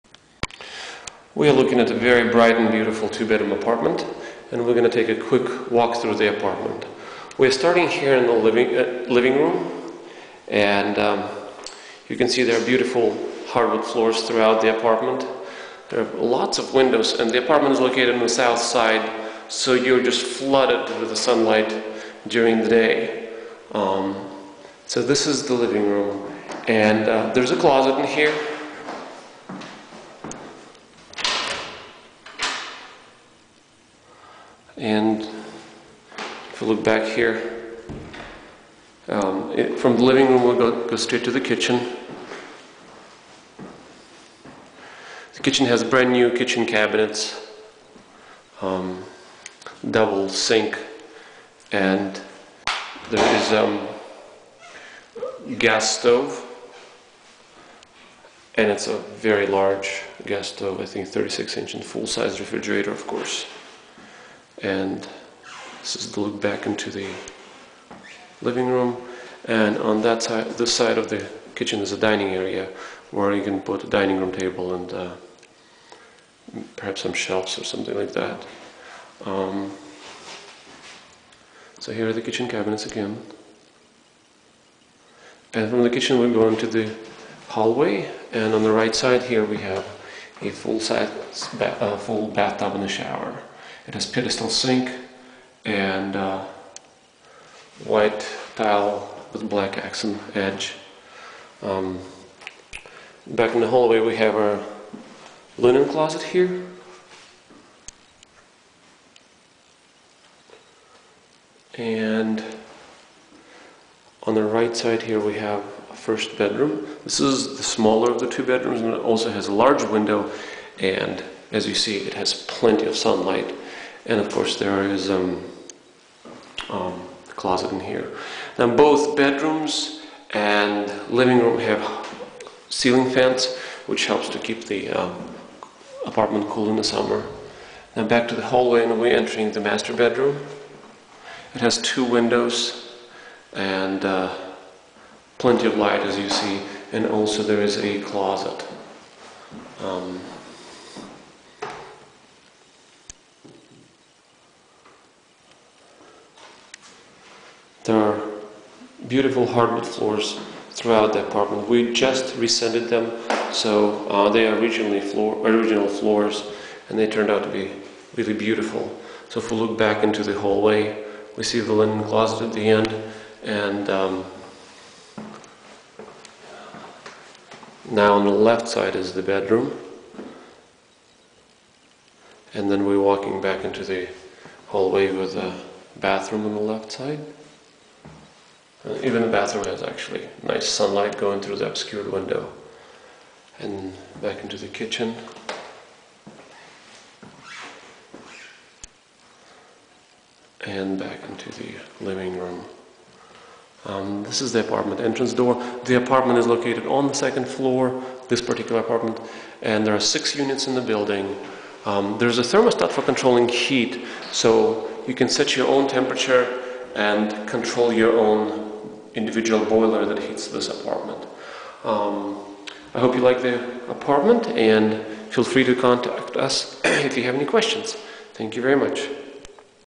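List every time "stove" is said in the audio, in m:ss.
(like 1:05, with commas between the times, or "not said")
0:55, 1:00.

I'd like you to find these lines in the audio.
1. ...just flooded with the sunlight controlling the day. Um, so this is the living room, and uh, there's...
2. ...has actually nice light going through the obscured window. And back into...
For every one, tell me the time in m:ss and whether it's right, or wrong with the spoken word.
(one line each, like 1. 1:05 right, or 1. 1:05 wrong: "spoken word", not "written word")
1. 0:20 wrong: "during", not "controlling"
2. 3:09 wrong: "sunlight", not "light".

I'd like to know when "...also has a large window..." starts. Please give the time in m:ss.
1:59.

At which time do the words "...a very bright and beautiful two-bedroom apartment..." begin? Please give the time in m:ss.
0:01.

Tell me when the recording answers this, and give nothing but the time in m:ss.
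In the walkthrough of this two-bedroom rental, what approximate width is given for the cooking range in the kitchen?
1:01.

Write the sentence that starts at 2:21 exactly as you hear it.
It has two windows and uh, plenty of light as you see and also there is a closet.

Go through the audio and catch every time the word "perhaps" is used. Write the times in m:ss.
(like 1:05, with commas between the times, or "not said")
1:16.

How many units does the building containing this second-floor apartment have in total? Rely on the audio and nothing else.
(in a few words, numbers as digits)
6.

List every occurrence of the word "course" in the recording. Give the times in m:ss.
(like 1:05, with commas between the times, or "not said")
1:03, 2:04.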